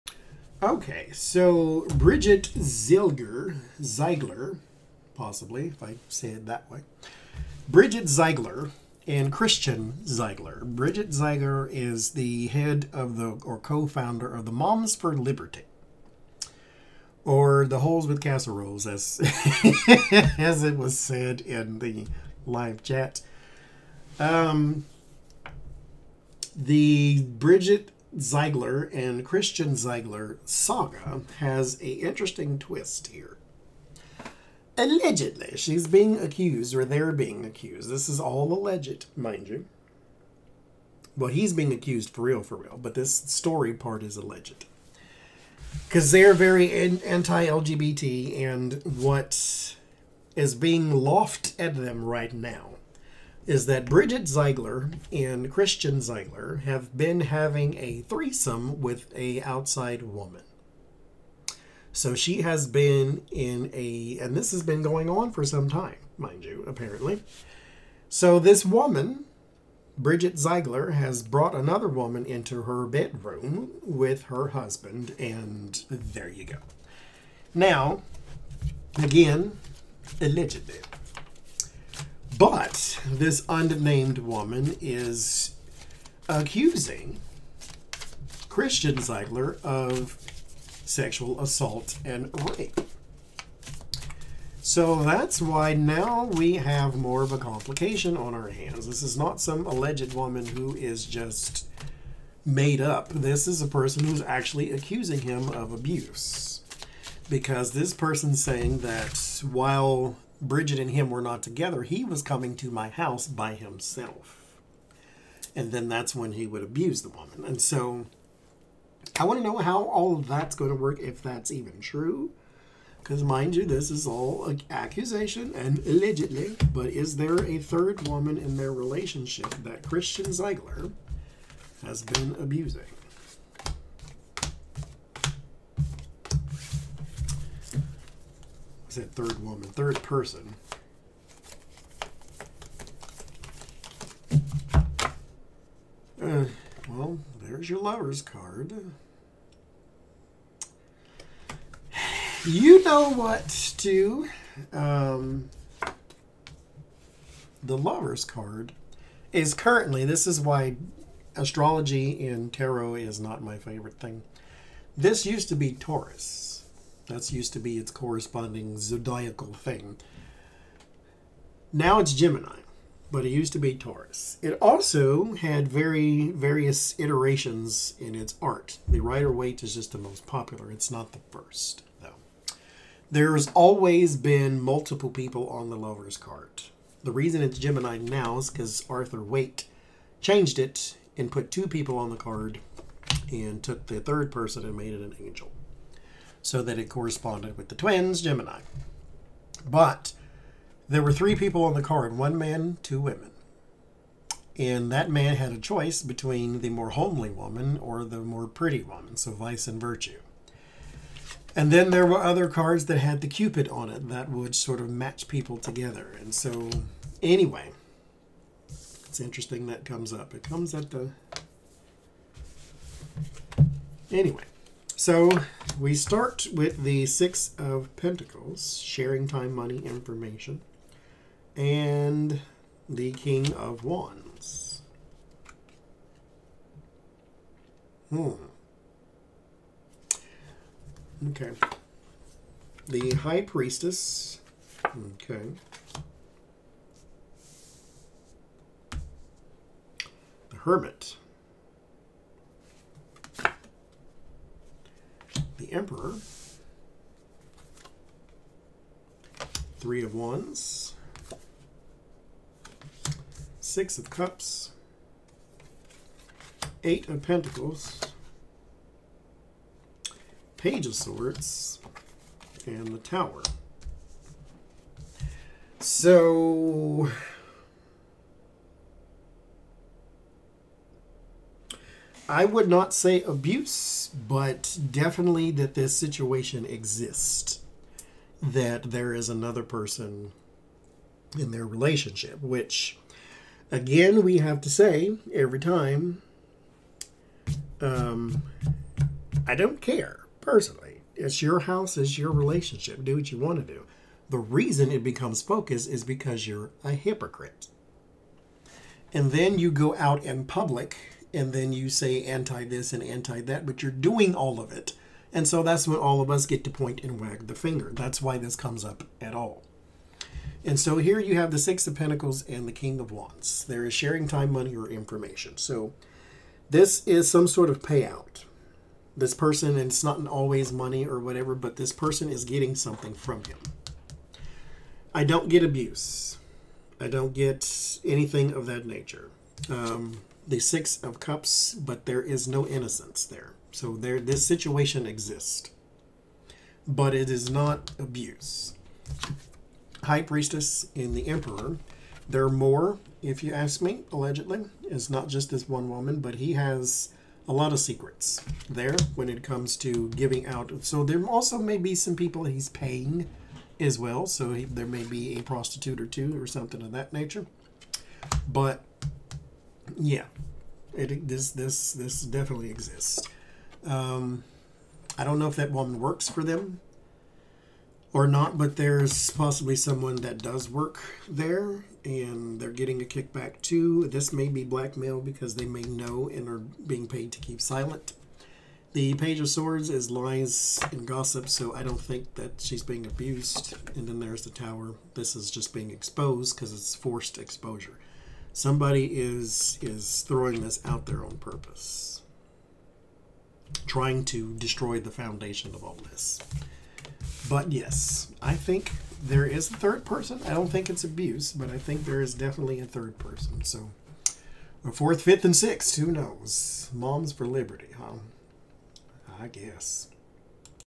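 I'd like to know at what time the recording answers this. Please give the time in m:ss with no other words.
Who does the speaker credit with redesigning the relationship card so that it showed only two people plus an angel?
3:08.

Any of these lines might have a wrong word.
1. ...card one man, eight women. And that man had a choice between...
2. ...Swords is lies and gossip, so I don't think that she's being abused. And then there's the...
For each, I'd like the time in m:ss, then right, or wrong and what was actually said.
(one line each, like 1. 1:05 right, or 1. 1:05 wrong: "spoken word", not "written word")
1. 3:21 wrong: "two", not "eight"
2. 6:29 right.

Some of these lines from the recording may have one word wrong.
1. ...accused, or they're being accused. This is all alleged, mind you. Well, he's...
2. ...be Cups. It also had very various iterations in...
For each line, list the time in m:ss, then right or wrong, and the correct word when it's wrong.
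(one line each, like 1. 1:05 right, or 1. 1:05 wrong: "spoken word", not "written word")
1. 0:36 right
2. 2:53 wrong: "Taurus", not "Cups".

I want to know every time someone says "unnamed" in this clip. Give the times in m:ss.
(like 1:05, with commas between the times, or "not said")
1:23.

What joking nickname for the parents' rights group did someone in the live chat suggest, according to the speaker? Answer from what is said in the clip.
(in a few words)
Holes with Casseroles.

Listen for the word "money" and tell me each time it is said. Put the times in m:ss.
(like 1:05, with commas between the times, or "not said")
3:49, 5:24, 5:30.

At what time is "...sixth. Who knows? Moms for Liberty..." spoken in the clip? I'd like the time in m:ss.
6:55.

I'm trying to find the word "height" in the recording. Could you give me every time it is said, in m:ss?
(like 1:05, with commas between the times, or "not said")
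not said.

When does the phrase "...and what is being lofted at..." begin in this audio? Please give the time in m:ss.
0:48.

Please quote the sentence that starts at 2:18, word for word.
I said third woman, third person.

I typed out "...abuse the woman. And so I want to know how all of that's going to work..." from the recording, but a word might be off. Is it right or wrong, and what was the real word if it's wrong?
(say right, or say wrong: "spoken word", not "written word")
right.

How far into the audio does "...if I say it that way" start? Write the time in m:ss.
0:05.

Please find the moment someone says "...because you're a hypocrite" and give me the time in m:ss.
5:06.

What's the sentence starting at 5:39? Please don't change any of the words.
Um, the Six of Cups, but there is no innocence there.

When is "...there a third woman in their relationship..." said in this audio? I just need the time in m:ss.
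2:07.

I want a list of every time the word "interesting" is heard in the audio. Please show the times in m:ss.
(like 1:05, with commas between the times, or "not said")
0:31, 3:39.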